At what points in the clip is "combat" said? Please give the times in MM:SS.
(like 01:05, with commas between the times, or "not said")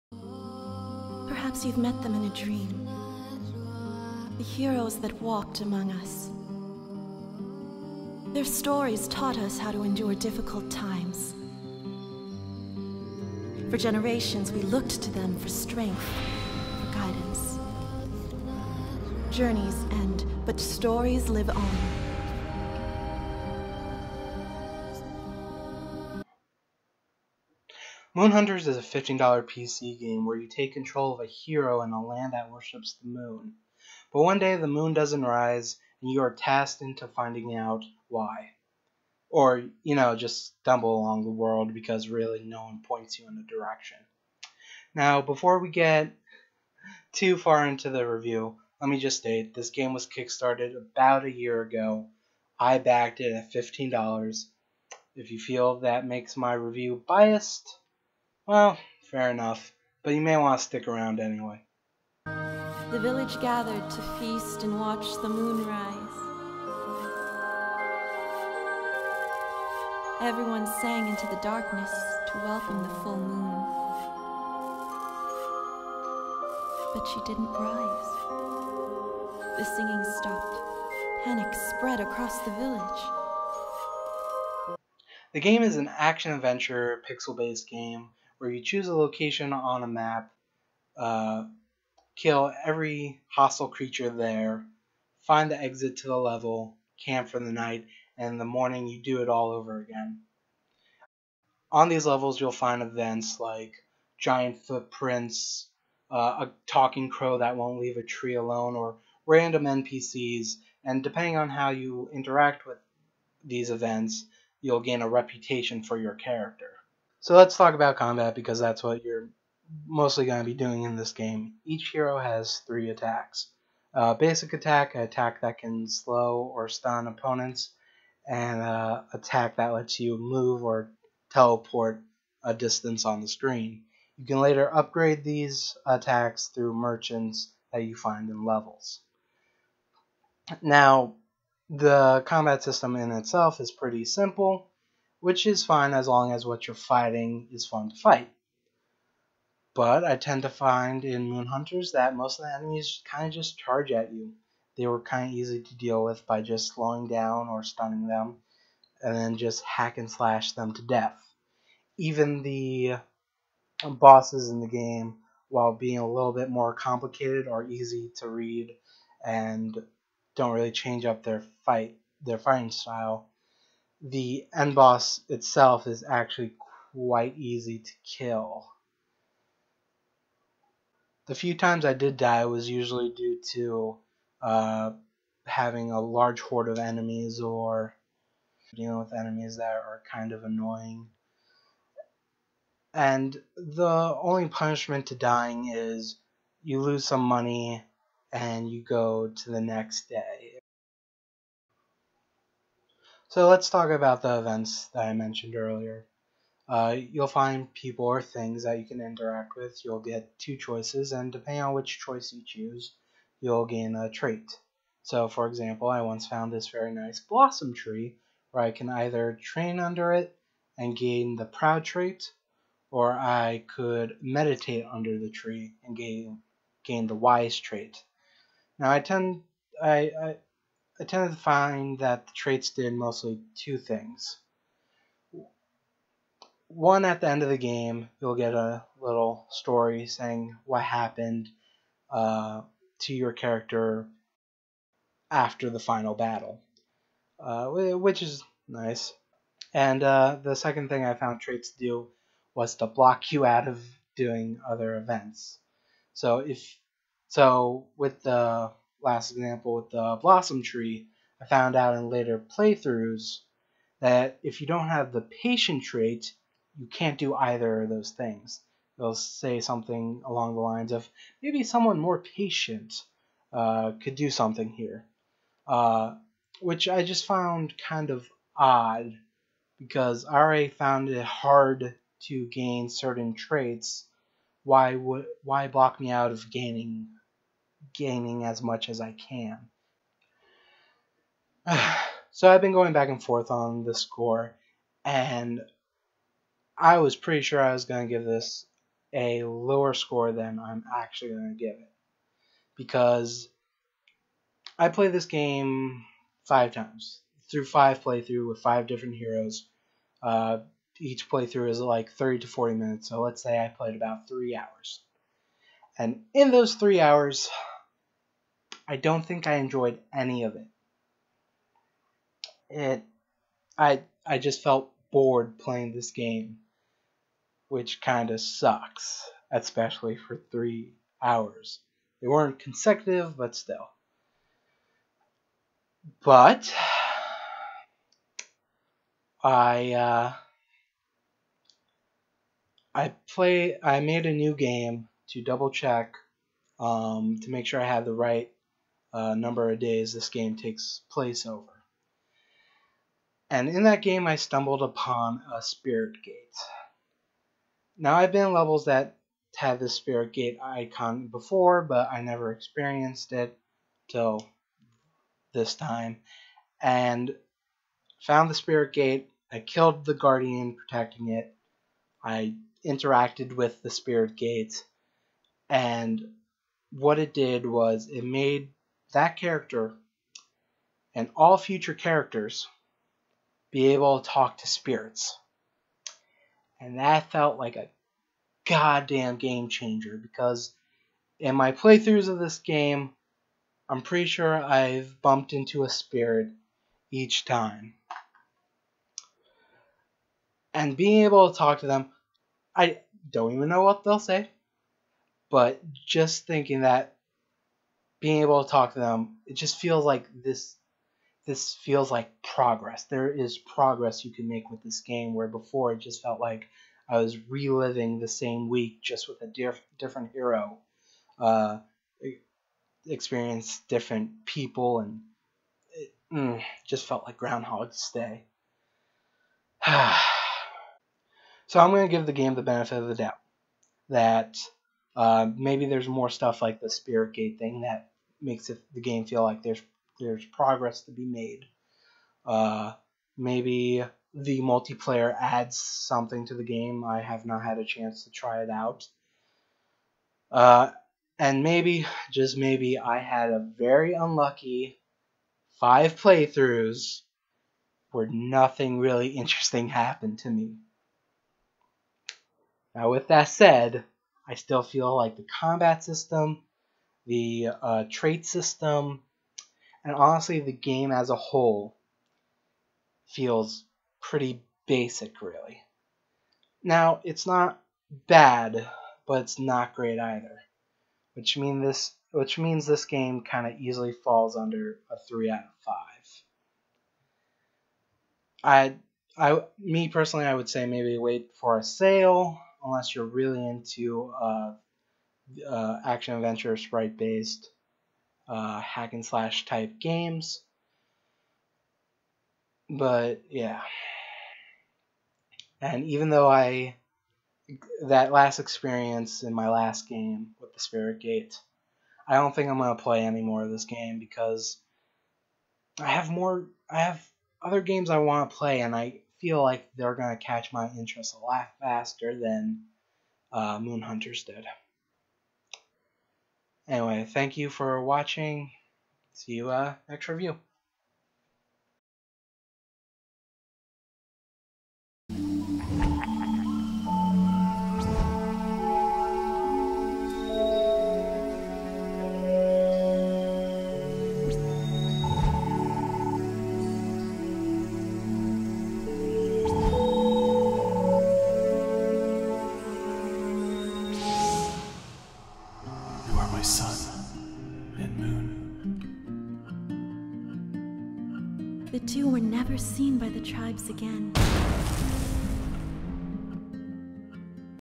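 01:57, 02:22, 07:45.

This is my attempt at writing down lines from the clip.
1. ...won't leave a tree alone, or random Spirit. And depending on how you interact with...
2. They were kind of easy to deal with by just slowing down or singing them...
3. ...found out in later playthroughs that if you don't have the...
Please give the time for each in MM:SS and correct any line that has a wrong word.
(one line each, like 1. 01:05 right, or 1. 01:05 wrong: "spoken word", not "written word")
1. 01:47 wrong: "NPCs", not "Spirit"
2. 02:34 wrong: "stunning", not "singing"
3. 04:21 right.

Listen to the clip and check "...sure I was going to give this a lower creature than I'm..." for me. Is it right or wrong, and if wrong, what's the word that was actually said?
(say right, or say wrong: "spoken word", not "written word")
wrong: "score", not "creature".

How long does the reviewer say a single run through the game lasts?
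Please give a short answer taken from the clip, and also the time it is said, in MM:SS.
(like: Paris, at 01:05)
30 to 40 minutes, at 05:12.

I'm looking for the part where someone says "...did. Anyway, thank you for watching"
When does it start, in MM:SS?
08:44.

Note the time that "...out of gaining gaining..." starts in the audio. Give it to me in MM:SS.
04:46.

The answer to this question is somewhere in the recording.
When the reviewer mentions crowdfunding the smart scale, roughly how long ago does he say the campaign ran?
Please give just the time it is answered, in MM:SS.
00:50.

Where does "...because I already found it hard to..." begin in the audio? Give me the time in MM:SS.
04:39.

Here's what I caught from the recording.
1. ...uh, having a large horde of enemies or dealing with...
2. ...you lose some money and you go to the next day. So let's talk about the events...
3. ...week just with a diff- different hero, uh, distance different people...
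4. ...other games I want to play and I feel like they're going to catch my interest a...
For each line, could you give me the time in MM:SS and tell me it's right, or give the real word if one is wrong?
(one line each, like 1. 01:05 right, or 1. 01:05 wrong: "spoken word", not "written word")
1. 03:04 right
2. 03:16 right
3. 06:58 wrong: "experience", not "distance"
4. 08:37 right.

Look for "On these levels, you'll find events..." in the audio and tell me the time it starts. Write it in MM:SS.
01:41.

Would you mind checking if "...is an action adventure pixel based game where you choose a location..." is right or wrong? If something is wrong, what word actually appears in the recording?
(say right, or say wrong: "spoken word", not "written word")
right.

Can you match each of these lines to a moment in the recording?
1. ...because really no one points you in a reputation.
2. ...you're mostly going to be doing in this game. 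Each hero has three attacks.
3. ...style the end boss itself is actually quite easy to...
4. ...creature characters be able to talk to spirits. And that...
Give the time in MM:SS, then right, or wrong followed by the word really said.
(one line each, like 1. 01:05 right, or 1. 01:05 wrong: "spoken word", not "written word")
1. 00:41 wrong: "direction", not "reputation"
2. 01:59 right
3. 02:52 right
4. 06:21 wrong: "future", not "creature".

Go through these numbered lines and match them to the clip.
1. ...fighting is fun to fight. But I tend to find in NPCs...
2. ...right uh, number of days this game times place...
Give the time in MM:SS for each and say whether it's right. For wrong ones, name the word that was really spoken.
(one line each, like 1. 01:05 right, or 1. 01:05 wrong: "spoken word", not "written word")
1. 02:26 wrong: "Moon", not "NPCs"
2. 05:48 wrong: "takes", not "times".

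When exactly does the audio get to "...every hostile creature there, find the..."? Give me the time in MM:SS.
01:32.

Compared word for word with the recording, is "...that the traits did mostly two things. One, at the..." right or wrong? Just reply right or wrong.
right.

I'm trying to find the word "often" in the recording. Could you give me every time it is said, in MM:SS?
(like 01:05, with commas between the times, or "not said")
not said.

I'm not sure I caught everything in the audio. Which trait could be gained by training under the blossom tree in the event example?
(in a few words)
proud.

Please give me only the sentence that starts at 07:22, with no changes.
Uh, maybe the multiplayer adds something to the game.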